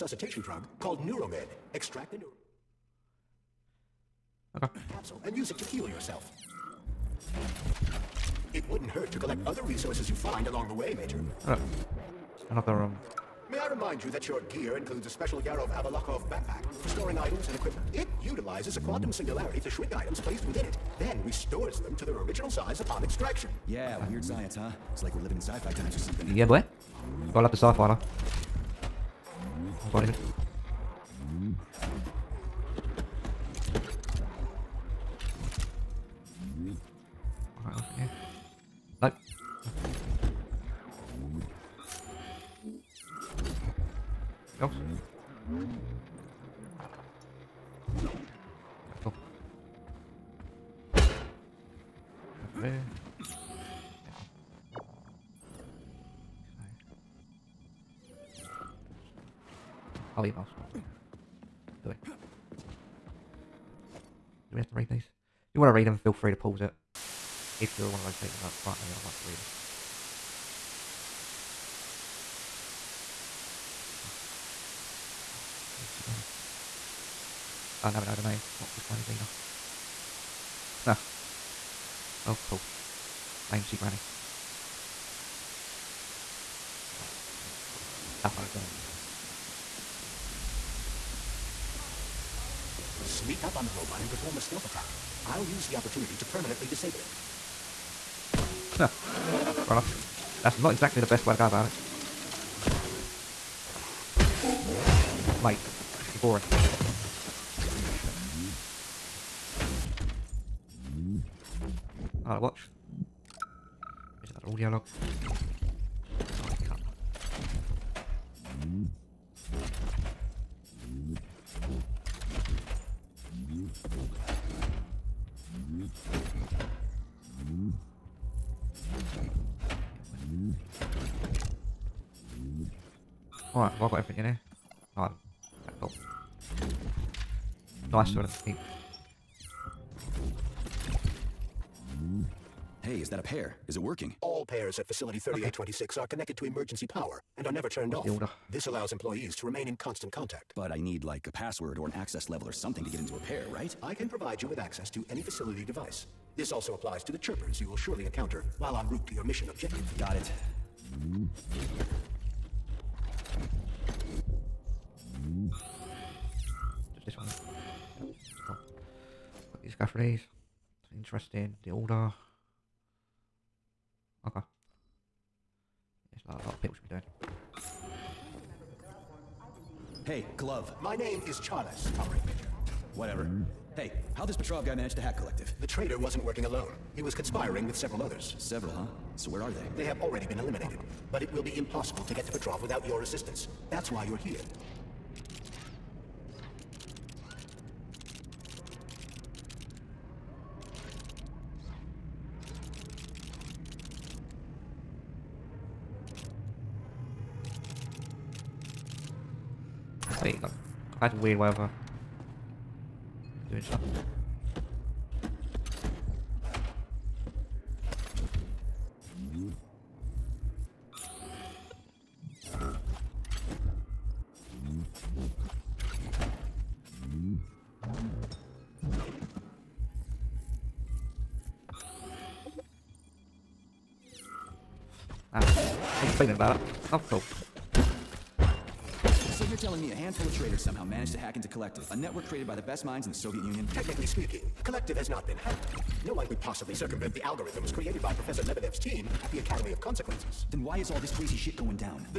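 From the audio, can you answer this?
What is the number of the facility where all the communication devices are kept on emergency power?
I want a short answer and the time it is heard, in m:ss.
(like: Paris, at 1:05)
3826, at 2:25.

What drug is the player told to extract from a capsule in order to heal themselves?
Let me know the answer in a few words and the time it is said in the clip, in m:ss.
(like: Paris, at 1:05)
Neuromed, at 0:01.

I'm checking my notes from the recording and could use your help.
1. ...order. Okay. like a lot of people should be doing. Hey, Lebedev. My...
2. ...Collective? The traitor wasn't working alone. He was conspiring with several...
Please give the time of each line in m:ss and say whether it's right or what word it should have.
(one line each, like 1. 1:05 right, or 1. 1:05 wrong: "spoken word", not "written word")
1. 2:51 wrong: "Glove", not "Lebedev"
2. 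3:05 right.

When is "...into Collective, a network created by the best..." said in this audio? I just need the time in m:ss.
4:01.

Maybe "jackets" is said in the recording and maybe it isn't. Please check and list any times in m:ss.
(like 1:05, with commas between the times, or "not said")
not said.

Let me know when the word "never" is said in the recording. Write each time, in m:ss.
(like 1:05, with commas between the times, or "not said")
1:17, 2:27.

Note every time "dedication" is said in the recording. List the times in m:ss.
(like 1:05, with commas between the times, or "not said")
not said.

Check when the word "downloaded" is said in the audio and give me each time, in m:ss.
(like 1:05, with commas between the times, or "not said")
not said.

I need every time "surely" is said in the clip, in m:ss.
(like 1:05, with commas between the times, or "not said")
2:37.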